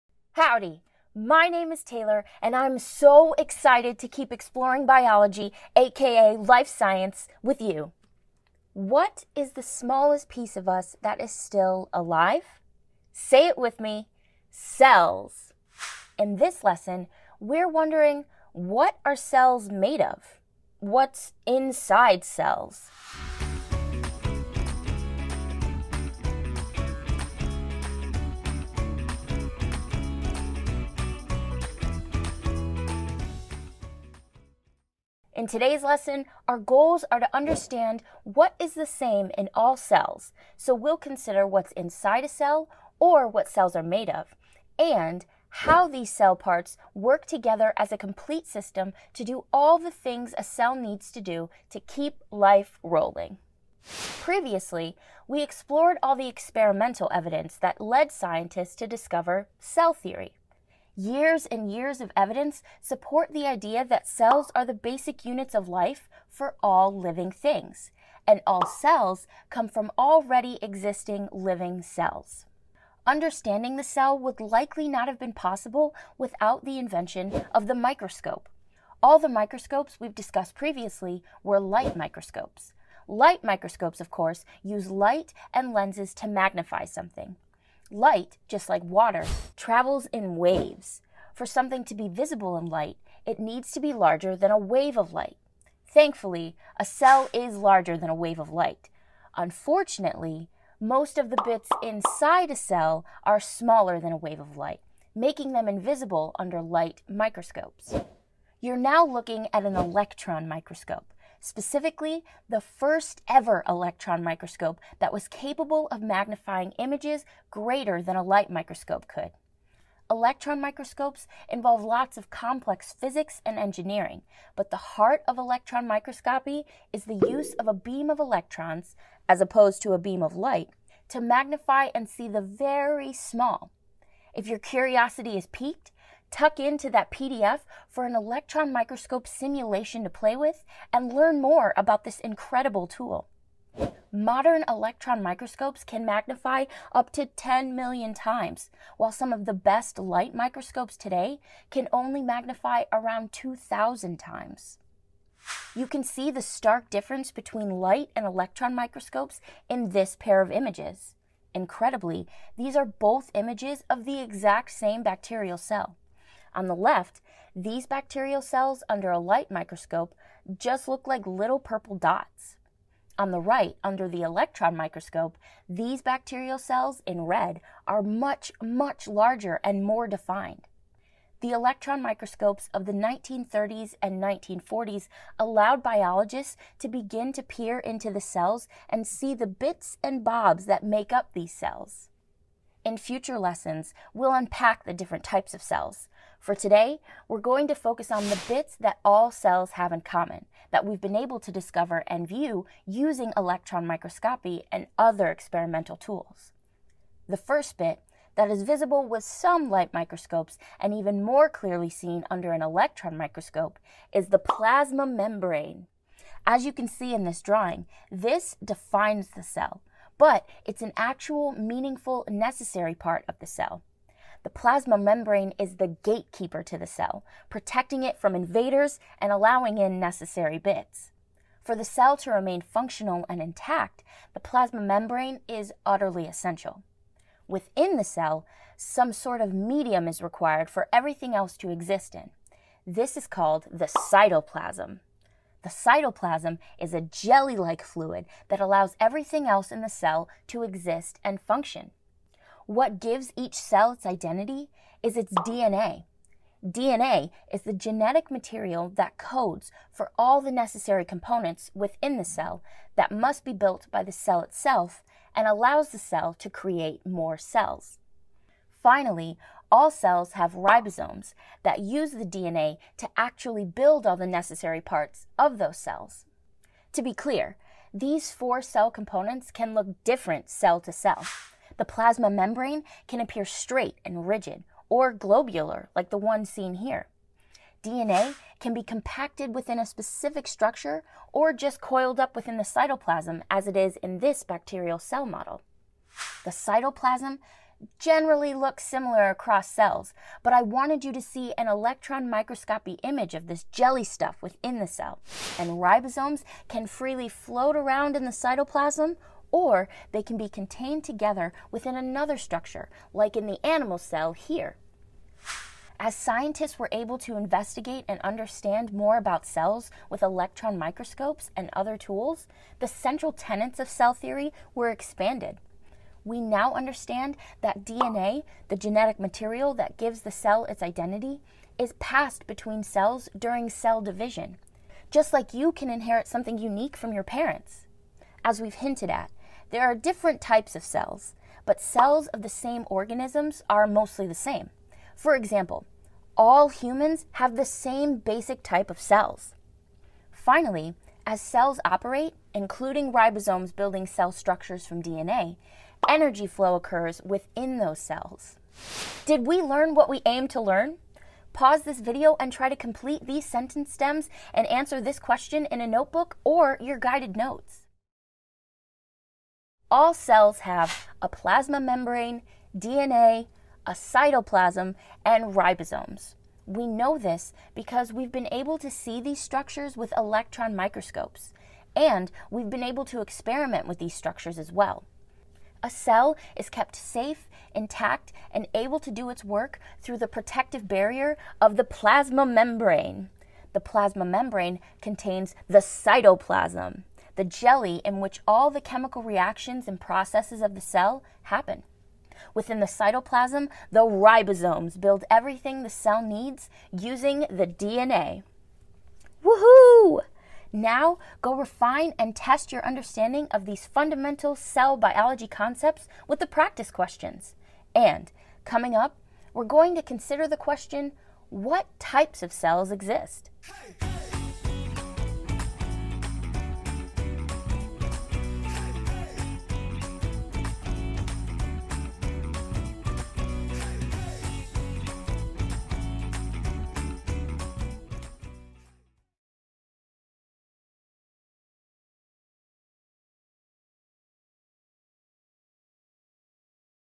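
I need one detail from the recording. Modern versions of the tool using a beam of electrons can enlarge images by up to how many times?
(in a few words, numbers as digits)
10 million.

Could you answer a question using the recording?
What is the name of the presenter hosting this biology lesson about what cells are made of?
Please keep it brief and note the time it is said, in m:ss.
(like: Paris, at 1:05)
Taylor, at 0:01.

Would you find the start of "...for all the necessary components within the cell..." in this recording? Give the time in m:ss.
4:19.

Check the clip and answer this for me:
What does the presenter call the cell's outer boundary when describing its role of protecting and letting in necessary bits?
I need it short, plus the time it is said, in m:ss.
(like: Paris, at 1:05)
gatekeeper, at 3:46.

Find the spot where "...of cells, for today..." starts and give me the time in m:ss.
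3:15.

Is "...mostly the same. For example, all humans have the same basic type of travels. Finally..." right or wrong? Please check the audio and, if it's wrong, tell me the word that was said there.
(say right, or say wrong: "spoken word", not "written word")
wrong: "cells", not "travels".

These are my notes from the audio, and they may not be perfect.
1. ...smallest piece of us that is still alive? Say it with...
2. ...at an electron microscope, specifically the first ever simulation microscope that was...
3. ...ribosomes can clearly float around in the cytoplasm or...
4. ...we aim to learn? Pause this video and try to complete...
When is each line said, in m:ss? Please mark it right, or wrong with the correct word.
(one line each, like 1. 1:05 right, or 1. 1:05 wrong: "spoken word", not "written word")
1. 0:09 right
2. 1:49 wrong: "electron", not "simulation"
3. 5:05 wrong: "freely", not "clearly"
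4. 6:00 right.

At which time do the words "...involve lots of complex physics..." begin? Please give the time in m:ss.
2:01.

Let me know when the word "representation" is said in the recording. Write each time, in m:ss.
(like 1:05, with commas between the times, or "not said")
not said.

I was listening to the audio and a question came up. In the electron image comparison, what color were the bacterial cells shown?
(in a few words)
red.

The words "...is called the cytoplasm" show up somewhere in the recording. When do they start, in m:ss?
4:03.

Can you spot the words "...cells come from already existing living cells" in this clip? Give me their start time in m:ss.
1:08.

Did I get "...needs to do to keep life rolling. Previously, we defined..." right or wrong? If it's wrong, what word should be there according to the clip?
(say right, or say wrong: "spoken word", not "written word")
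wrong: "explored", not "defined".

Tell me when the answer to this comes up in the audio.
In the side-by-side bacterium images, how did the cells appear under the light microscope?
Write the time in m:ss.
2:51.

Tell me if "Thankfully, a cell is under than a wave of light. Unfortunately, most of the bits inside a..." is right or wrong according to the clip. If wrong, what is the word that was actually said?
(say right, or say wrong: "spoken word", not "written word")
wrong: "larger", not "under".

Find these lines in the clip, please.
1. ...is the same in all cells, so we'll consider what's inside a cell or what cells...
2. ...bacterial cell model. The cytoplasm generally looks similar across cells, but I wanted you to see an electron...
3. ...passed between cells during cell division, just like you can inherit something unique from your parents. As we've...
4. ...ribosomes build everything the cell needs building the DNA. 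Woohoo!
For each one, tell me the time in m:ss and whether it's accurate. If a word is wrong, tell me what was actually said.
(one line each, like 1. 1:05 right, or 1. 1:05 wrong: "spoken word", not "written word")
1. 0:38 right
2. 4:54 right
3. 5:31 right
4. 6:44 wrong: "using", not "building".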